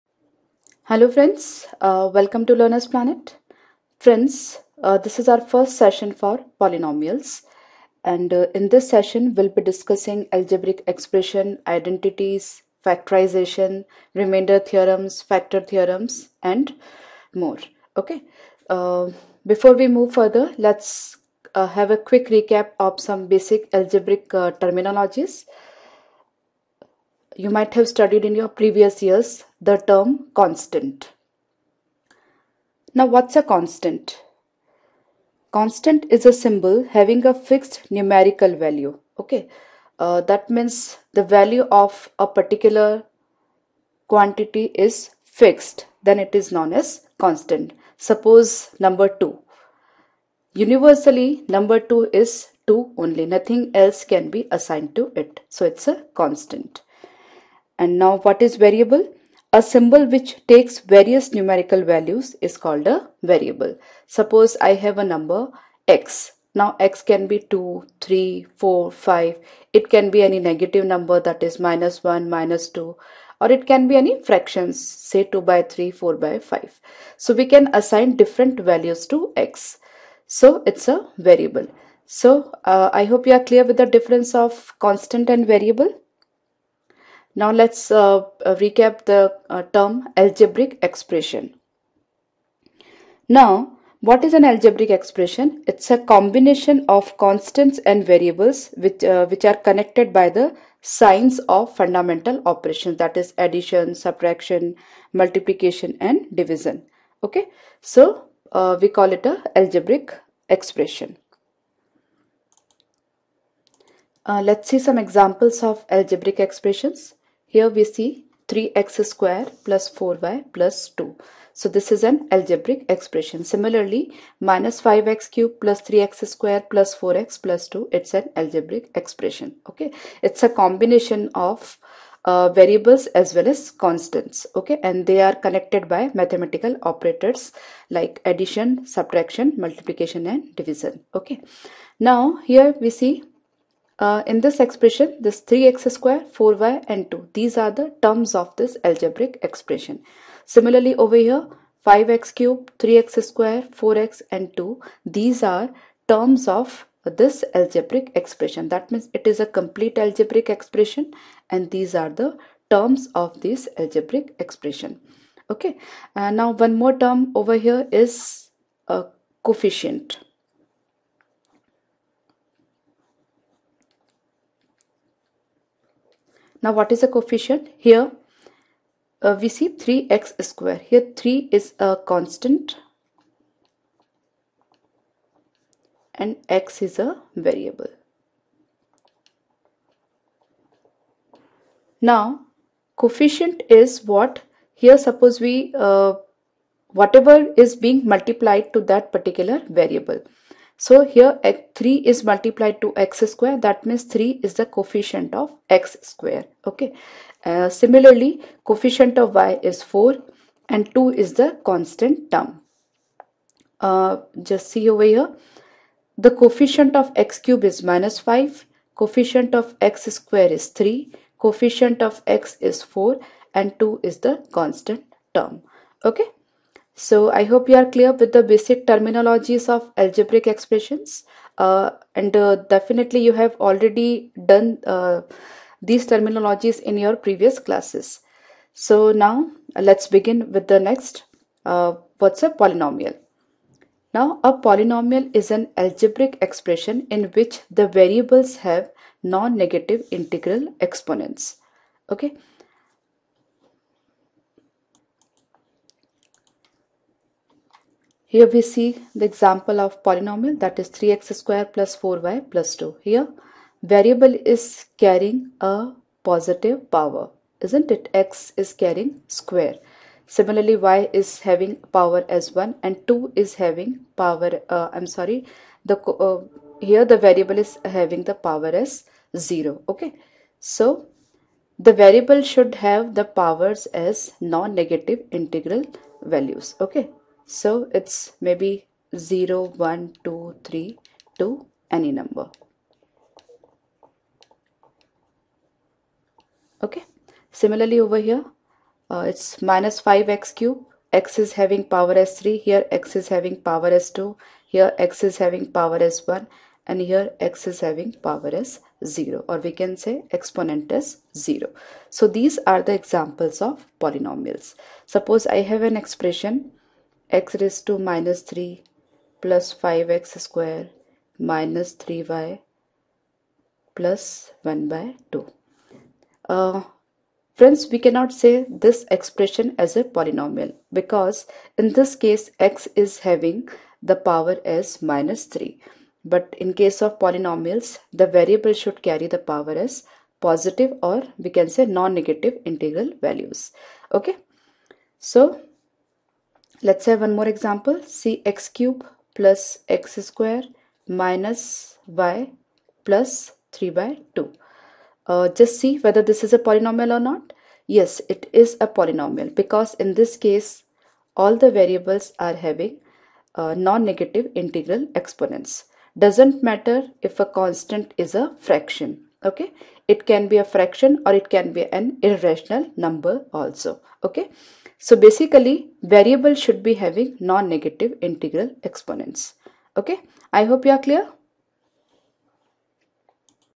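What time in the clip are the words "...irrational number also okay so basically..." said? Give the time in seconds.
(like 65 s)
372 s.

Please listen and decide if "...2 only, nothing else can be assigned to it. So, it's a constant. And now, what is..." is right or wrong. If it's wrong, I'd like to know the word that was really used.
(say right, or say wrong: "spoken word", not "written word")
right.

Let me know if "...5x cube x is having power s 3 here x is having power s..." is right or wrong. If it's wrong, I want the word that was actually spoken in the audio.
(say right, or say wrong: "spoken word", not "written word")
right.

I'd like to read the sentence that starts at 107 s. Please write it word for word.
Okay, so uh, we call it a algebraic expression.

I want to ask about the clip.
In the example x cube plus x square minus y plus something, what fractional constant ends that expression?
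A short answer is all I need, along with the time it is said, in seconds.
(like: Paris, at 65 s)
3/2, at 353 s.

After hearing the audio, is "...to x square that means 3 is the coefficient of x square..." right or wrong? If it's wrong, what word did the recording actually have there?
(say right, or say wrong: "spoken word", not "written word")
right.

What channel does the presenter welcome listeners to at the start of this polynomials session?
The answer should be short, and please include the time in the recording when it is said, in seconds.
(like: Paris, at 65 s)
Learner's Planet, at 2 s.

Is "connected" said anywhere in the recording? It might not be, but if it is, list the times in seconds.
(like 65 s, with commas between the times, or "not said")
99 s, 135 s.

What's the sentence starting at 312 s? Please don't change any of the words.
So these are the examples of polynomials.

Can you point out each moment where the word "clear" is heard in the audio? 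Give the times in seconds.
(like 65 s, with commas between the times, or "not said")
83 s, 227 s, 381 s.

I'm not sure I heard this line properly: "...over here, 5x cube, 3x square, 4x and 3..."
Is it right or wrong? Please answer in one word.
wrong.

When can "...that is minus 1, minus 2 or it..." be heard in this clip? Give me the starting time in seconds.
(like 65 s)
71 s.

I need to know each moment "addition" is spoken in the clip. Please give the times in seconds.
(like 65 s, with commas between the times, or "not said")
103 s, 138 s.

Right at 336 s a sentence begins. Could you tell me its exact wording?
But in case of polynomials, the variable should carry the power as positive or we can say non-negative integral values.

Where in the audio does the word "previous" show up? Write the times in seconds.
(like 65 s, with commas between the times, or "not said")
28 s, 237 s.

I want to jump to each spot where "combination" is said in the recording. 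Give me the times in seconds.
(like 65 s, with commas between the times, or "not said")
95 s, 130 s.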